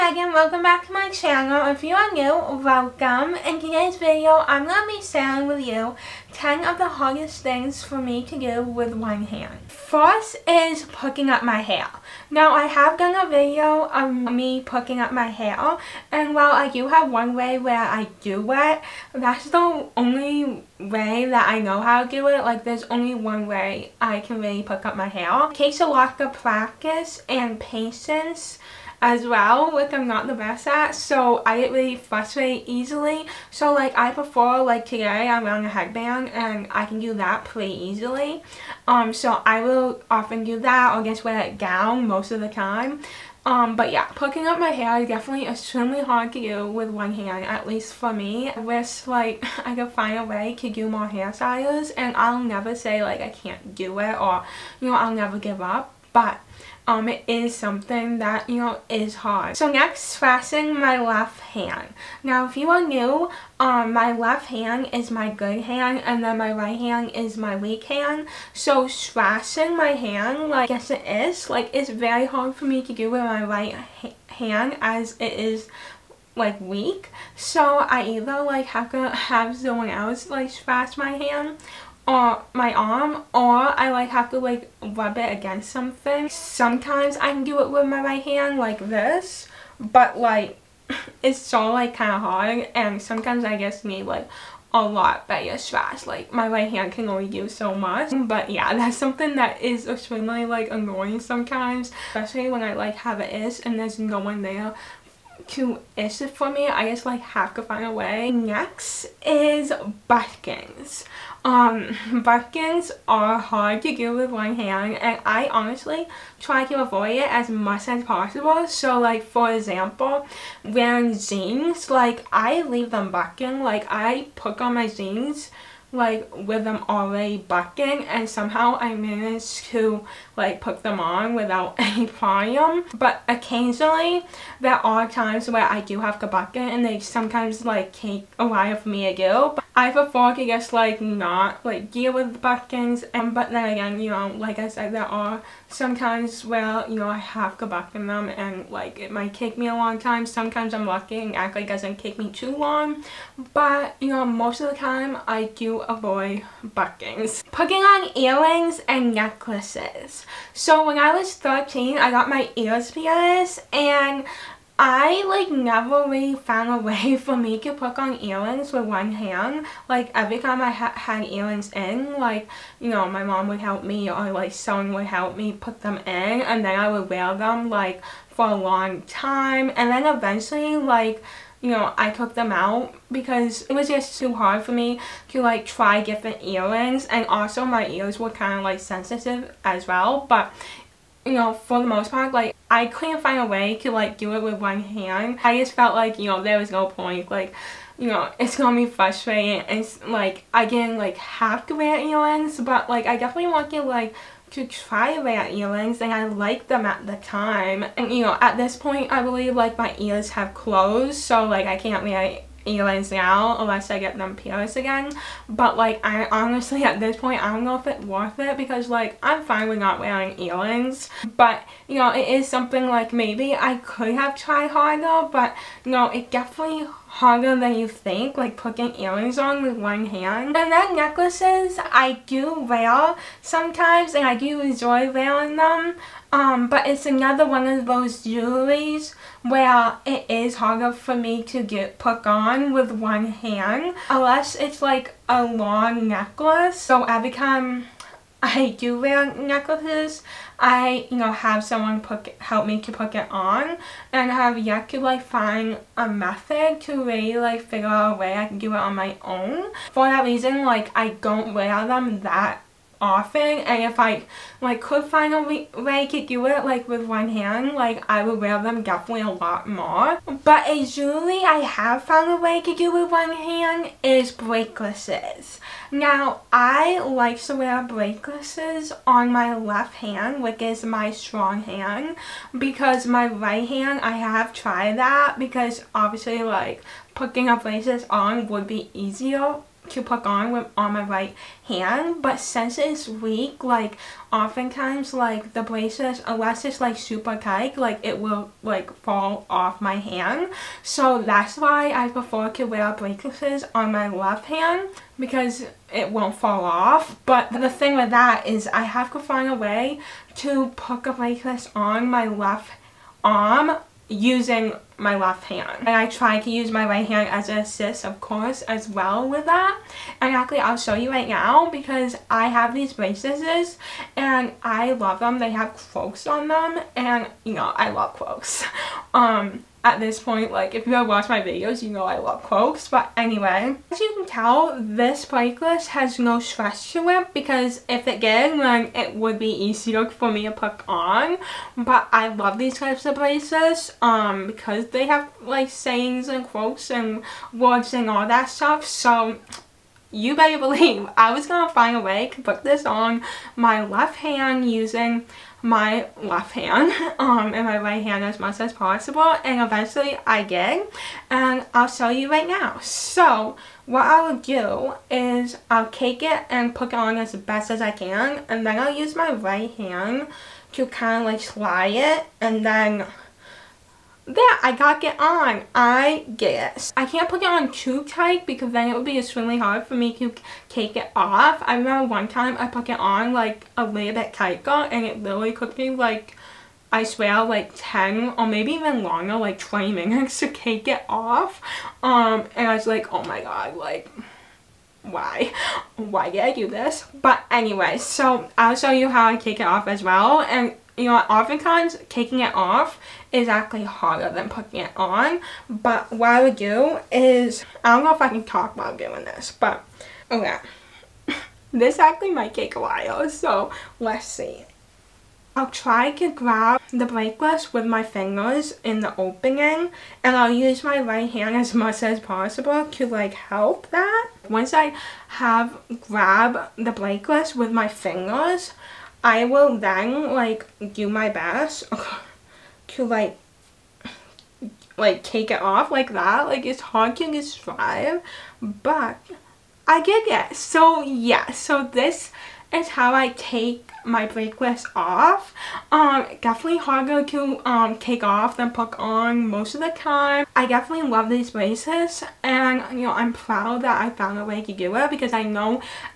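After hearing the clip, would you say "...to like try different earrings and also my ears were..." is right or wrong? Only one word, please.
right.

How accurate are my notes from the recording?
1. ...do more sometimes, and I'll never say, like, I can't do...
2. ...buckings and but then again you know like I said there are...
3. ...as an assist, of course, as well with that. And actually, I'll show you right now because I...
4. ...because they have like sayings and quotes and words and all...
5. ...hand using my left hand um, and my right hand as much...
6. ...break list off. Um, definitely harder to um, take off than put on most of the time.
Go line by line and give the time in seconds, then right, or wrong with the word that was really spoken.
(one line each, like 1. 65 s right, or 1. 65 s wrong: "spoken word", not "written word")
1. 50 s wrong: "hairstyles", not "sometimes"
2. 142 s right
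3. 317 s right
4. 344 s right
5. 354 s right
6. 444 s right.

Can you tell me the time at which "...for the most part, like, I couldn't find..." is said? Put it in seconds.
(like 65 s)
191 s.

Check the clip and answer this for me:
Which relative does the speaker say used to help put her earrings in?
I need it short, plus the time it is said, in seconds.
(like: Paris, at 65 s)
mom, at 173 s.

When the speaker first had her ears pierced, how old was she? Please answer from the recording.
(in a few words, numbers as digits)
13.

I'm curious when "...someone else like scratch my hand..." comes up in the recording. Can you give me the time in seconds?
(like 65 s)
79 s.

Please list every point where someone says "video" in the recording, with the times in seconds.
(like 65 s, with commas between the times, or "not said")
3 s, 13 s, 331 s.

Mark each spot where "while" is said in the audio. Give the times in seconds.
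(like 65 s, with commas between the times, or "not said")
16 s, 138 s, 412 s.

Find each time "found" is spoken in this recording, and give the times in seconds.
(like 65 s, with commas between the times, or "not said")
166 s, 272 s, 454 s.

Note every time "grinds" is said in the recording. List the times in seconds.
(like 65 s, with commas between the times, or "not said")
not said.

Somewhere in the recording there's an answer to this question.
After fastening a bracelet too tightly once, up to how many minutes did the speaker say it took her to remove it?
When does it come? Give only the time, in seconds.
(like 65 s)
389 s.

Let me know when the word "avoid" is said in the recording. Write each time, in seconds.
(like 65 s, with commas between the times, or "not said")
116 s, 155 s.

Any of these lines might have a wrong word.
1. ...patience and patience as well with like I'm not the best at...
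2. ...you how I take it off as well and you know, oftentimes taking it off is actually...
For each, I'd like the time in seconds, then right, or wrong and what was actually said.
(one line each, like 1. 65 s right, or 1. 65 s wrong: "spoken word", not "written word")
1. 26 s wrong: "practice", not "patience"
2. 398 s right.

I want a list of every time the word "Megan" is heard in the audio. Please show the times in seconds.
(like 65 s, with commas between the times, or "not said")
0 s.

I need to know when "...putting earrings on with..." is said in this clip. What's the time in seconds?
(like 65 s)
228 s.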